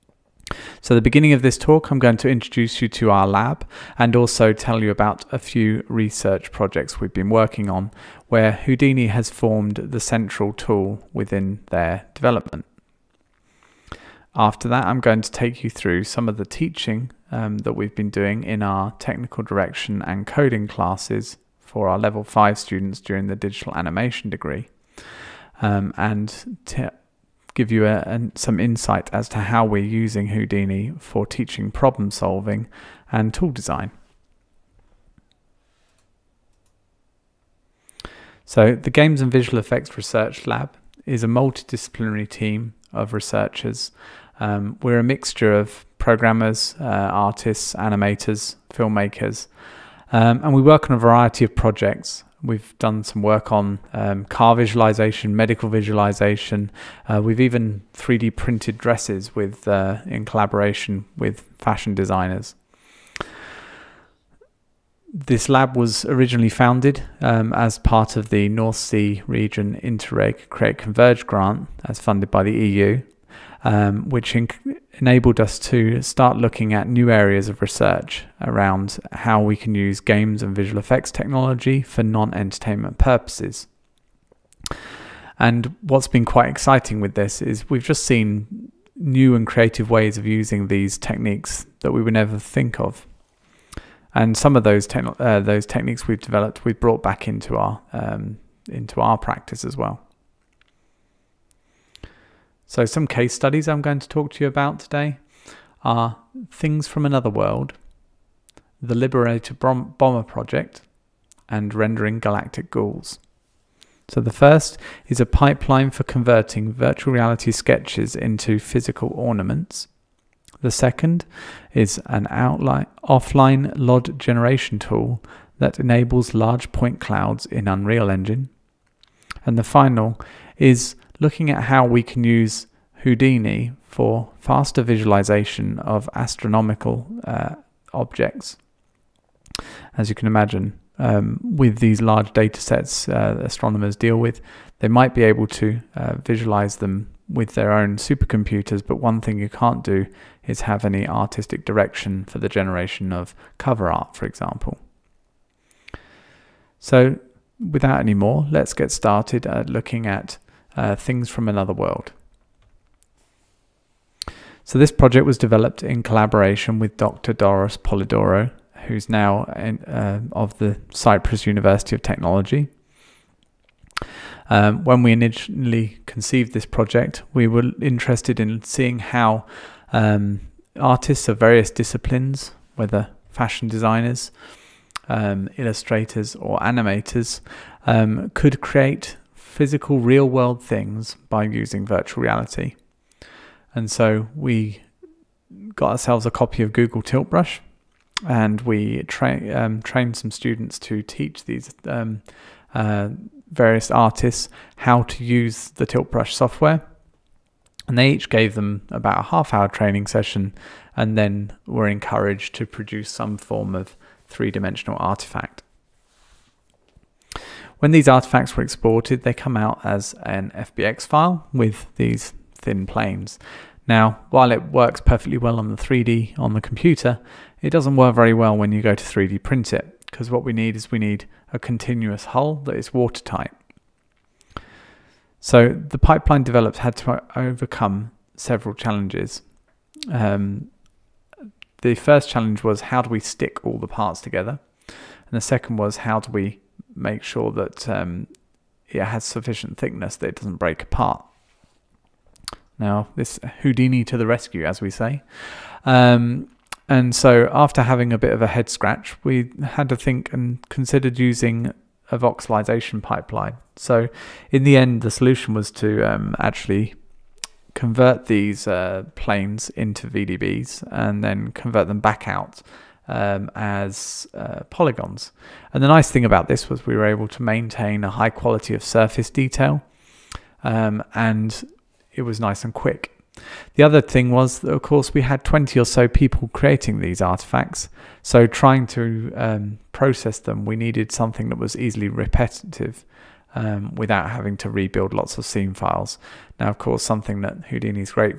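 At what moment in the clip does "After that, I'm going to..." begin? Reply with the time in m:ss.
0:14.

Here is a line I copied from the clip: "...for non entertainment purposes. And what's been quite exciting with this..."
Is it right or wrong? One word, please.
right.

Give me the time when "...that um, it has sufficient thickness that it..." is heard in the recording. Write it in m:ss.
4:07.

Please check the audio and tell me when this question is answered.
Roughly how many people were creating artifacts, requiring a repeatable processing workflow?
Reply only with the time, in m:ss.
4:45.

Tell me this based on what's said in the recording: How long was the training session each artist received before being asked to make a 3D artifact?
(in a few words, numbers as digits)
half hour.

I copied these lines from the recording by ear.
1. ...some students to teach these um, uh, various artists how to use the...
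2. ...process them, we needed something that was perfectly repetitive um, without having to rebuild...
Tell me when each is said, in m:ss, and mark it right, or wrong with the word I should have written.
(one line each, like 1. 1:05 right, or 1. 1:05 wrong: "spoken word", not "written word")
1. 3:20 right
2. 4:49 wrong: "easily", not "perfectly".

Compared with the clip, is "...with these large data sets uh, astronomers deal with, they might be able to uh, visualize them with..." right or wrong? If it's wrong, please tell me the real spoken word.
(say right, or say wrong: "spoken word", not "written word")
right.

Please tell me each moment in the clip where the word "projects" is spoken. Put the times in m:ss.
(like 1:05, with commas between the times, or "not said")
0:06, 0:51, 1:50, 2:44, 2:56.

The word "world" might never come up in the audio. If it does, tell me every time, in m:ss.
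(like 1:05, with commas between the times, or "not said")
1:47, 2:41, 3:10.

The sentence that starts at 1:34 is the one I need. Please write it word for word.
And some of those te uh, those techniques we've developed, we've brought back into our um, into our practice as well.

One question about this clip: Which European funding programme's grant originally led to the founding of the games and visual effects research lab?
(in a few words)
North Sea Region Interreg Create Converge.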